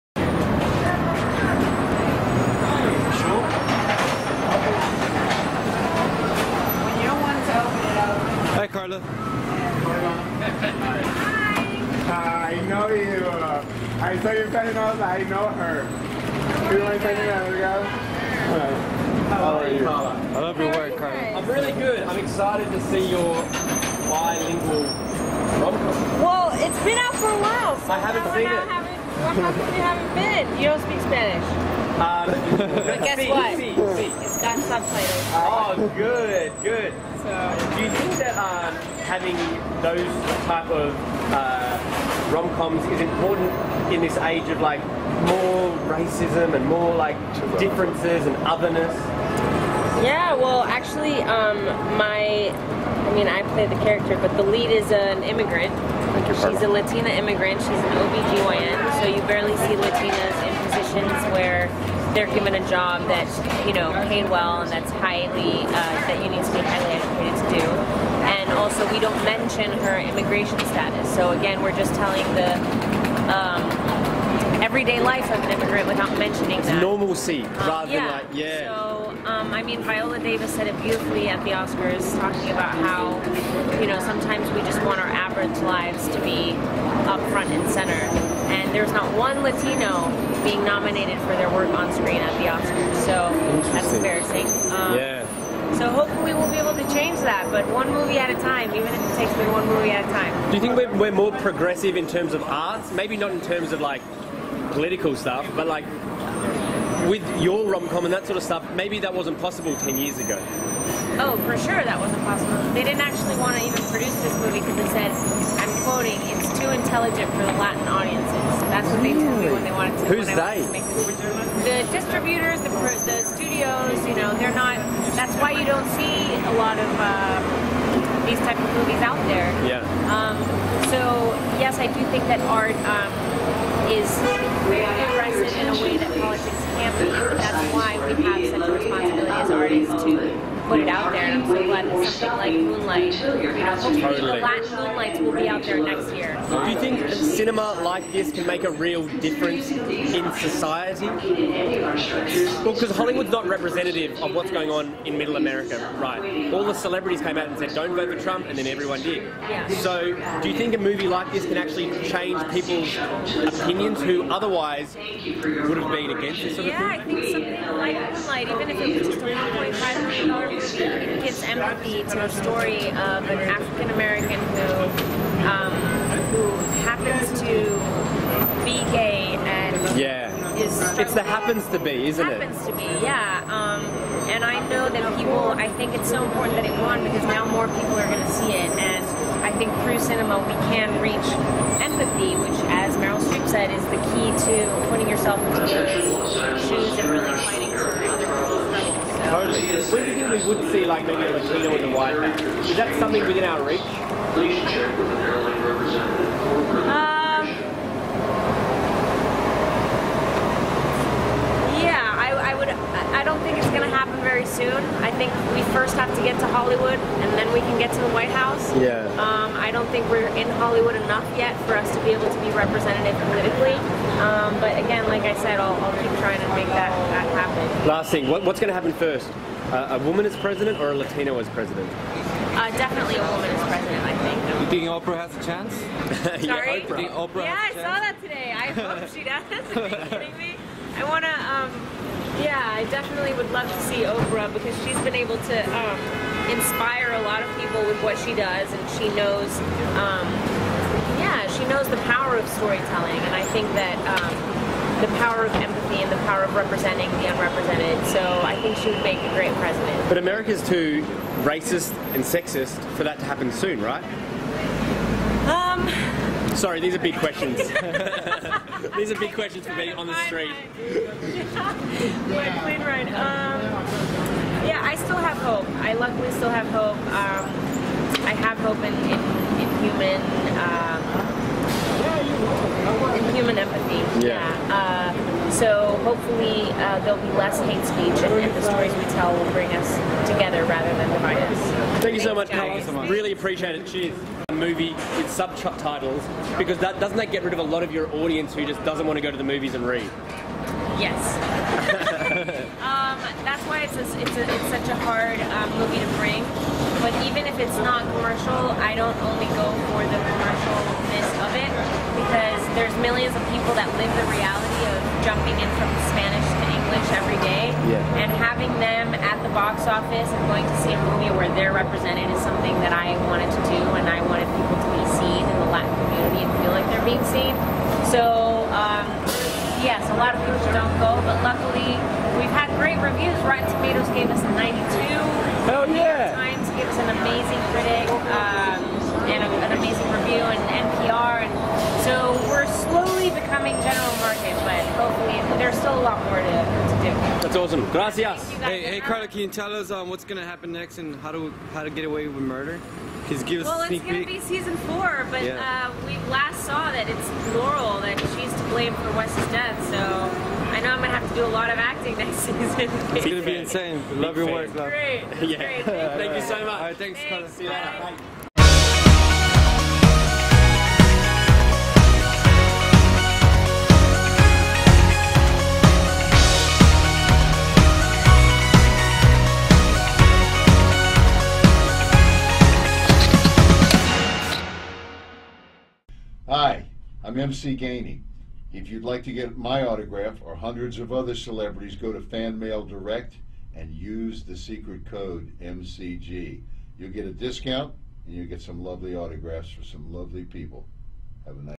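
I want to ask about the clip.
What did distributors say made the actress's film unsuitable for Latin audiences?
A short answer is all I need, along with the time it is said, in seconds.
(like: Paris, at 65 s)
too intelligent, at 116 s.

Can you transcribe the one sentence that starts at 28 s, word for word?
Haven't, how come you haven't been?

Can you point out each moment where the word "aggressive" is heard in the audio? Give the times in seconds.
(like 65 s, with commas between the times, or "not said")
135 s.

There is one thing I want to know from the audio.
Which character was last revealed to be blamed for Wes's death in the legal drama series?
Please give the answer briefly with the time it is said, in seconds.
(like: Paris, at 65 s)
Laurel, at 357 s.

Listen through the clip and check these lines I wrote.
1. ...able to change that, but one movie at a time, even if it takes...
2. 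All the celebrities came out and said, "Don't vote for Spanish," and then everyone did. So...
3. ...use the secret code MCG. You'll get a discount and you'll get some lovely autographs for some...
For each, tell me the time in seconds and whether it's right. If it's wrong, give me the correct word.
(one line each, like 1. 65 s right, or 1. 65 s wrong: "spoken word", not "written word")
1. 96 s right
2. 156 s wrong: "Trump", not "Spanish"
3. 393 s right.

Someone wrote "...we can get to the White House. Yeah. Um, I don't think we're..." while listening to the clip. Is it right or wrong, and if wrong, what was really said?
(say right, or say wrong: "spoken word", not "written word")
right.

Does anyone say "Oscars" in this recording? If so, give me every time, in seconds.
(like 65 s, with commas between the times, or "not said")
81 s, 92 s.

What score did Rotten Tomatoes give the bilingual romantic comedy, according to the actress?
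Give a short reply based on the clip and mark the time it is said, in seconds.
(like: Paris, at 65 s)
92, at 334 s.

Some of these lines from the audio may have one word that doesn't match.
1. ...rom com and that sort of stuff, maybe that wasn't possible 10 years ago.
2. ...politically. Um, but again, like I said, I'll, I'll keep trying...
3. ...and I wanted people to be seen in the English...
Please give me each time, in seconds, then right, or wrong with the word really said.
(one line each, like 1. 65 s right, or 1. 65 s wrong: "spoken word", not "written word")
1. 107 s right
2. 223 s right
3. 323 s wrong: "Latin", not "English".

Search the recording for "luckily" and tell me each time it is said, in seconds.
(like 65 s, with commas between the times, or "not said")
275 s, 331 s.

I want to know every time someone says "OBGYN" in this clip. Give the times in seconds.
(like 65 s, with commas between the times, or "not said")
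58 s.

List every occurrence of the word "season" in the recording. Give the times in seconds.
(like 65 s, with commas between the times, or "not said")
354 s, 362 s.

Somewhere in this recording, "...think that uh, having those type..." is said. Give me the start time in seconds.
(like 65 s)
37 s.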